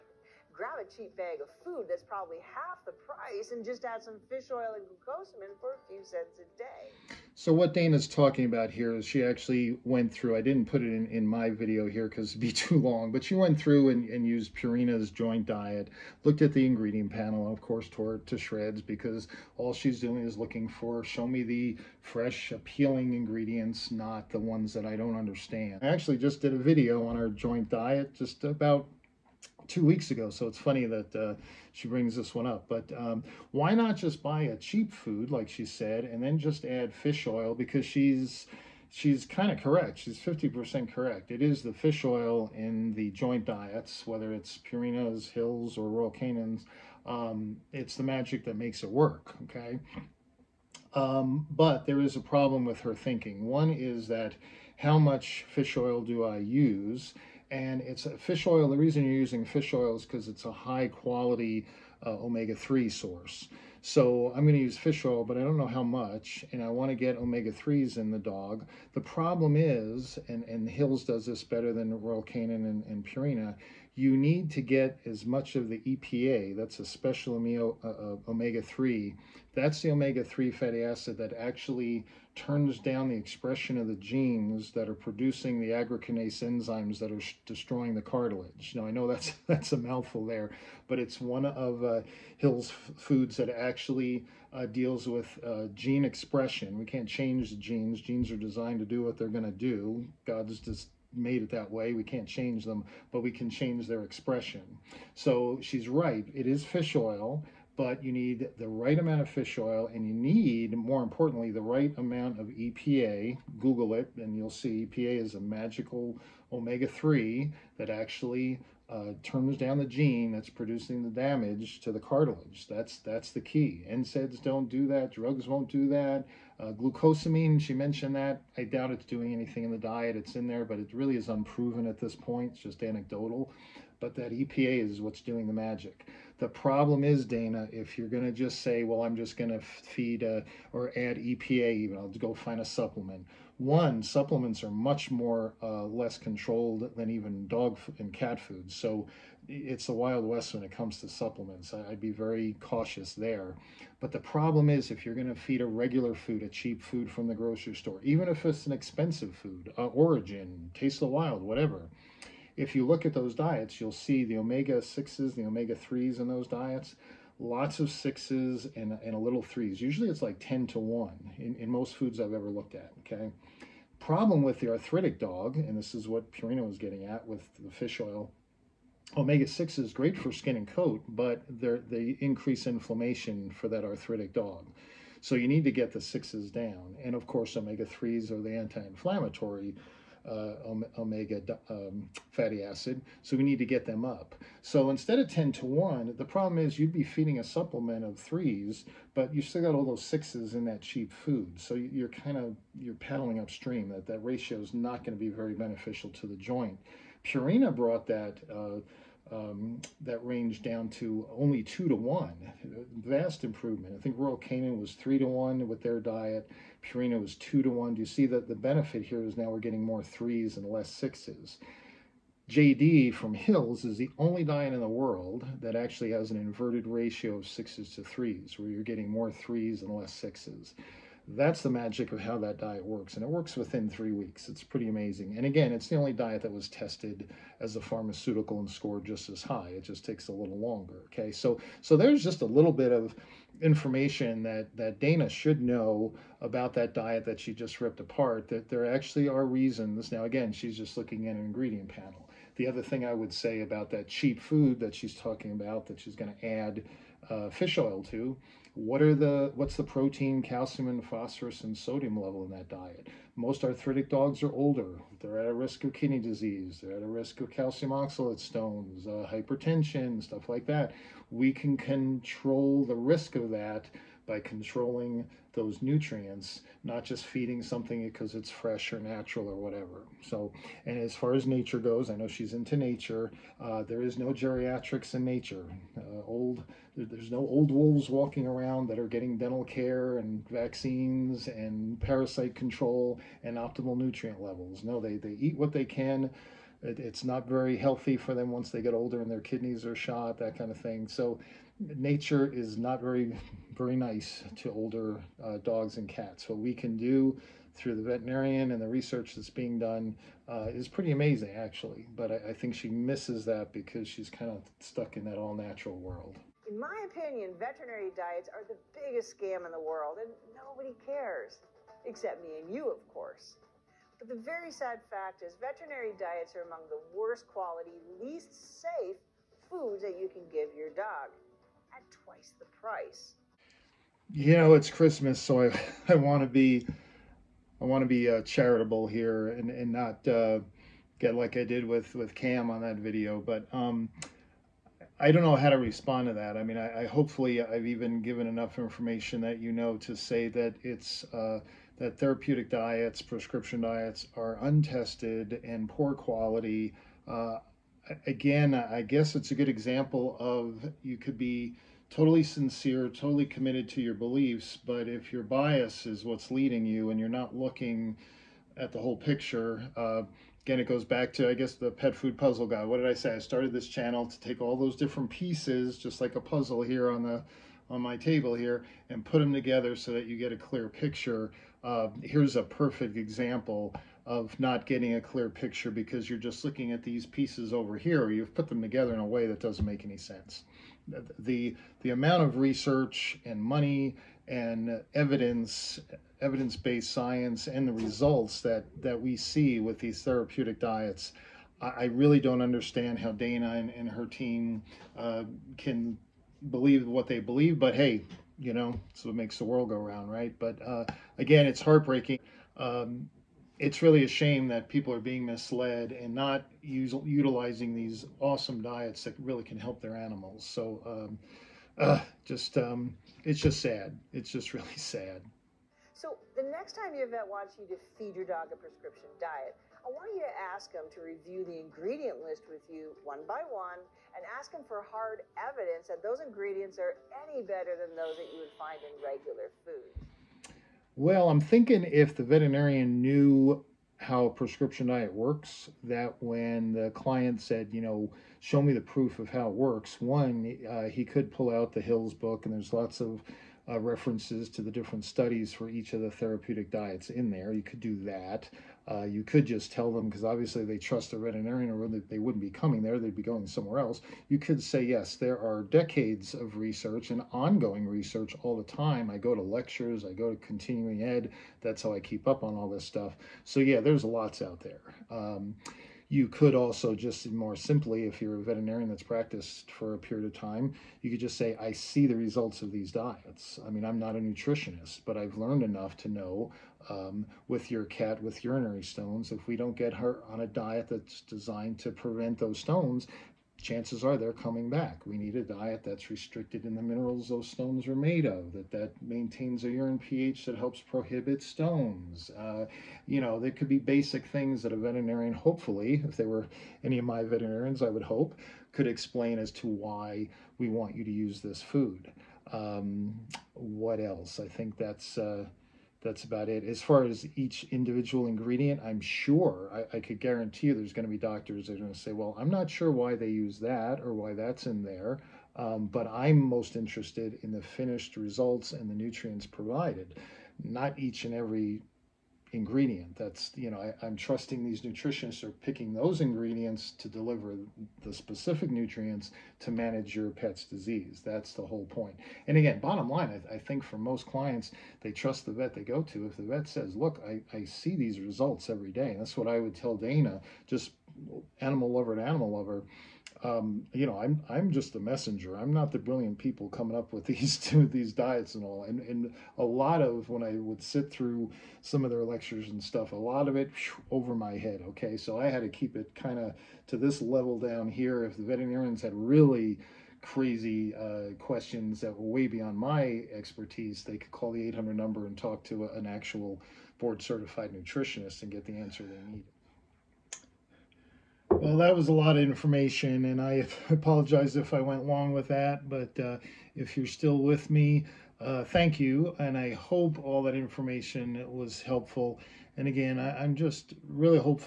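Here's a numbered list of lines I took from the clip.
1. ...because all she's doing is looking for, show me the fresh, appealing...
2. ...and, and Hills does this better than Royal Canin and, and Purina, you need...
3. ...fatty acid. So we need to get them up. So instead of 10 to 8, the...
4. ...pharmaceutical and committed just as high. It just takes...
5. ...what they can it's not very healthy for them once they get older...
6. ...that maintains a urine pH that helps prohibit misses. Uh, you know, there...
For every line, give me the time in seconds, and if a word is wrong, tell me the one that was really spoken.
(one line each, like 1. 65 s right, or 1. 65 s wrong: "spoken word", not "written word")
1. 18 s right
2. 70 s right
3. 192 s wrong: "1", not "8"
4. 237 s wrong: "scored", not "committed"
5. 295 s right
6. 498 s wrong: "stones", not "misses".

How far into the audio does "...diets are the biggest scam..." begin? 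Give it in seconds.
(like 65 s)
318 s.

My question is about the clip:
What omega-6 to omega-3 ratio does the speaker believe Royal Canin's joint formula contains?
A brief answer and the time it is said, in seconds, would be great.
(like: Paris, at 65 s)
3 to 1, at 214 s.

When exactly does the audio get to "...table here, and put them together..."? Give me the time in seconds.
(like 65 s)
378 s.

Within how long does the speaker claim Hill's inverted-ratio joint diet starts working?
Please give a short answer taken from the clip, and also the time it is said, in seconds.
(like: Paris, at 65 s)
3 weeks, at 233 s.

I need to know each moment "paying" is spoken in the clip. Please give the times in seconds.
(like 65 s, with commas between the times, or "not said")
not said.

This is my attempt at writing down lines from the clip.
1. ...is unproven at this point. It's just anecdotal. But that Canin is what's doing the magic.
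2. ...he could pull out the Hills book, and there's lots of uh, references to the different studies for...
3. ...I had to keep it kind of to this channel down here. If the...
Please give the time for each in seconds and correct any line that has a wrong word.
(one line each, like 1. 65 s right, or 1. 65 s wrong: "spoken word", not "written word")
1. 131 s wrong: "EPA", not "Canin"
2. 451 s right
3. 565 s wrong: "level", not "channel".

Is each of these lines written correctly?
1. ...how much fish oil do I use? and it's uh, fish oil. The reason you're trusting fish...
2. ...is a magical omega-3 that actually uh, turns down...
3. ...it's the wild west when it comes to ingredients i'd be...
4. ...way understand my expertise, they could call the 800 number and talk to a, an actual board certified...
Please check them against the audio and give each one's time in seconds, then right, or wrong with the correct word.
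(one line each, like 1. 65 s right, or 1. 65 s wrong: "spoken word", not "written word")
1. 54 s wrong: "using", not "trusting"
2. 115 s right
3. 149 s wrong: "supplements", not "ingredients"
4. 572 s wrong: "beyond", not "understand".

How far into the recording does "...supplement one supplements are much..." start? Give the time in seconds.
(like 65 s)
142 s.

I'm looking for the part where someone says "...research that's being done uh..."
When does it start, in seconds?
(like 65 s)
308 s.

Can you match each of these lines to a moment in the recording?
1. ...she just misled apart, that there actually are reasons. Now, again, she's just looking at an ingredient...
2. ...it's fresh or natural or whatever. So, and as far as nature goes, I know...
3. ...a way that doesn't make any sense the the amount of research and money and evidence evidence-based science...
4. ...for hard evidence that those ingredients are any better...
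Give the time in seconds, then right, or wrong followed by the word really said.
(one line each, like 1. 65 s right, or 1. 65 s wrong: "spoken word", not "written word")
1. 247 s wrong: "ripped", not "misled"
2. 278 s right
3. 389 s right
4. 434 s right.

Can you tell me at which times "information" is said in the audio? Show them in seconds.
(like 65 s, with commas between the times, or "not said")
243 s, 348 s, 582 s, 590 s.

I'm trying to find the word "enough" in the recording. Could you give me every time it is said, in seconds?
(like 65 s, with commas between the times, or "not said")
348 s, 485 s.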